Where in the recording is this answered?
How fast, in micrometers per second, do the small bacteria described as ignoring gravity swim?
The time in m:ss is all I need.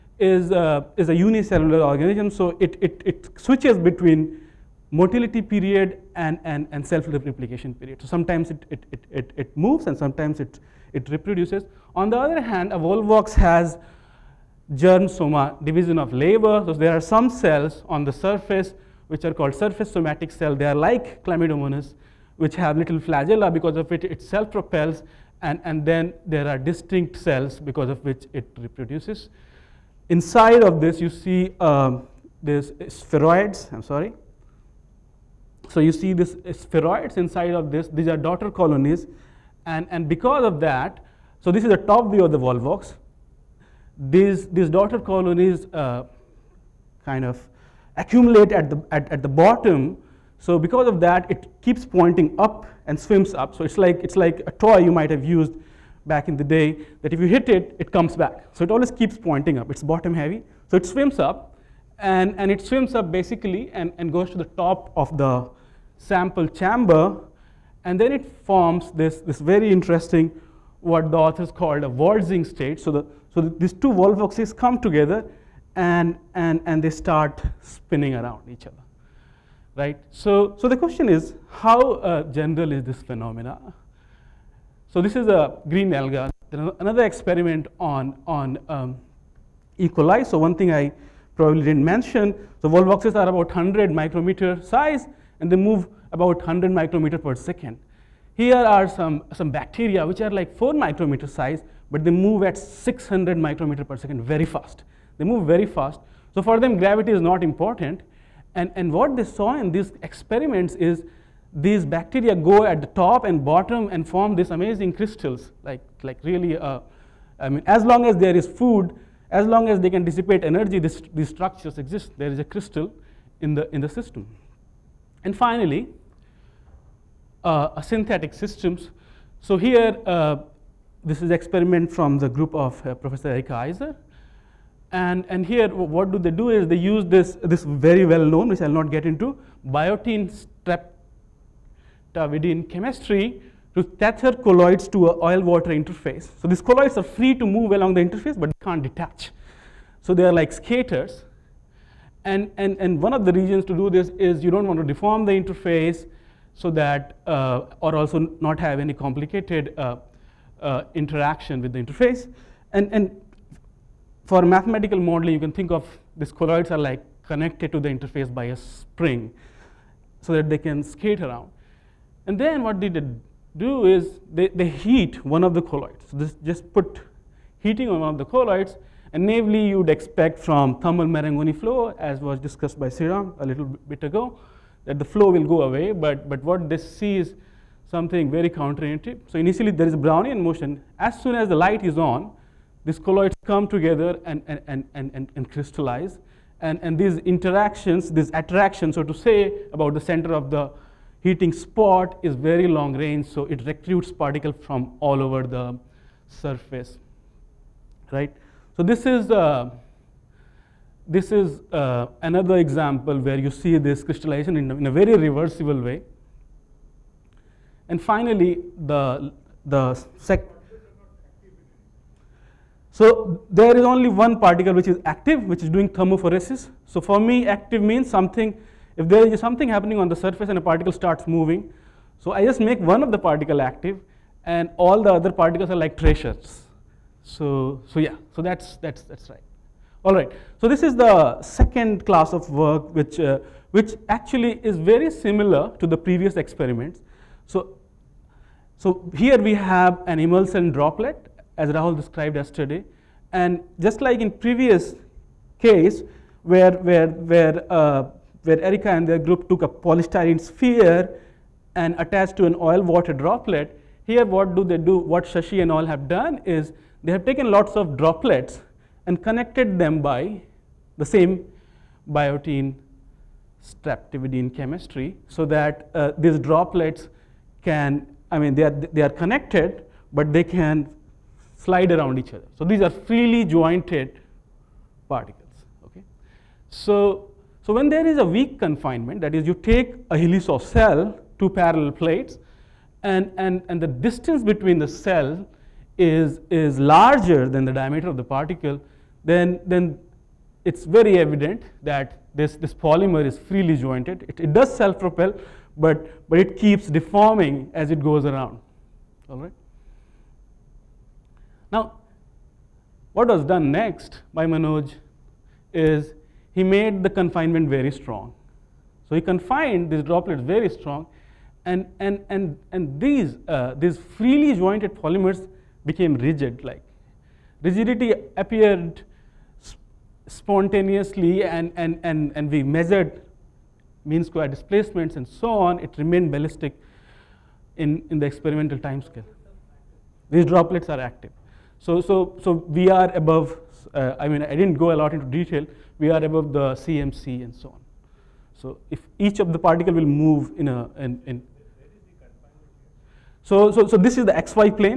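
1:42.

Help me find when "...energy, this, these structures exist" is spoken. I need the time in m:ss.
2:00.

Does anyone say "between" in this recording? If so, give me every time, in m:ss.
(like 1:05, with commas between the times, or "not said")
0:03, 4:54.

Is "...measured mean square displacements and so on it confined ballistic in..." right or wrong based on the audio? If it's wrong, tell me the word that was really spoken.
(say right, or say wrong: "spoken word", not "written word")
wrong: "remained", not "confined".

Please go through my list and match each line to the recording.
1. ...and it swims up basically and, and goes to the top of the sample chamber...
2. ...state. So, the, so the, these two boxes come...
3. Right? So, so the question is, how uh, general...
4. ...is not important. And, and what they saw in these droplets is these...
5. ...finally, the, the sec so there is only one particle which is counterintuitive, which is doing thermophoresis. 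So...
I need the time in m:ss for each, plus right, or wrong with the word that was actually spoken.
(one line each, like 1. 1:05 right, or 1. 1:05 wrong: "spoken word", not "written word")
1. 1:02 right
2. 1:12 right
3. 1:19 right
4. 1:47 wrong: "experiments", not "droplets"
5. 3:38 wrong: "active", not "counterintuitive".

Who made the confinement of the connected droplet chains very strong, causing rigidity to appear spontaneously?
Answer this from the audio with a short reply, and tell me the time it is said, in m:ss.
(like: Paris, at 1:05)
Manoj, at 5:14.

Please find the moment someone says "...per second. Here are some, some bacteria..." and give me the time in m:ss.
1:37.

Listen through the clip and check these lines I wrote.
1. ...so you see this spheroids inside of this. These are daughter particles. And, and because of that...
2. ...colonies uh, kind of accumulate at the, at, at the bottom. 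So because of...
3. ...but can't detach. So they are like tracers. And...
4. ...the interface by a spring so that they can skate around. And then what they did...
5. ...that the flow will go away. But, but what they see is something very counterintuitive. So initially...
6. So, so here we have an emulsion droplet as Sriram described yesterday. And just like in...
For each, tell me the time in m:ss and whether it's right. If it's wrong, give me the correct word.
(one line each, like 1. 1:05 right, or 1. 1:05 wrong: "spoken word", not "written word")
1. 0:35 wrong: "colonies", not "particles"
2. 0:44 right
3. 2:28 wrong: "skaters", not "tracers"
4. 2:47 right
5. 3:04 right
6. 4:07 wrong: "Rahul", not "Sriram".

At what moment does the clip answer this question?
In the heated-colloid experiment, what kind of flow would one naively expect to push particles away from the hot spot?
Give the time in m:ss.
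3:00.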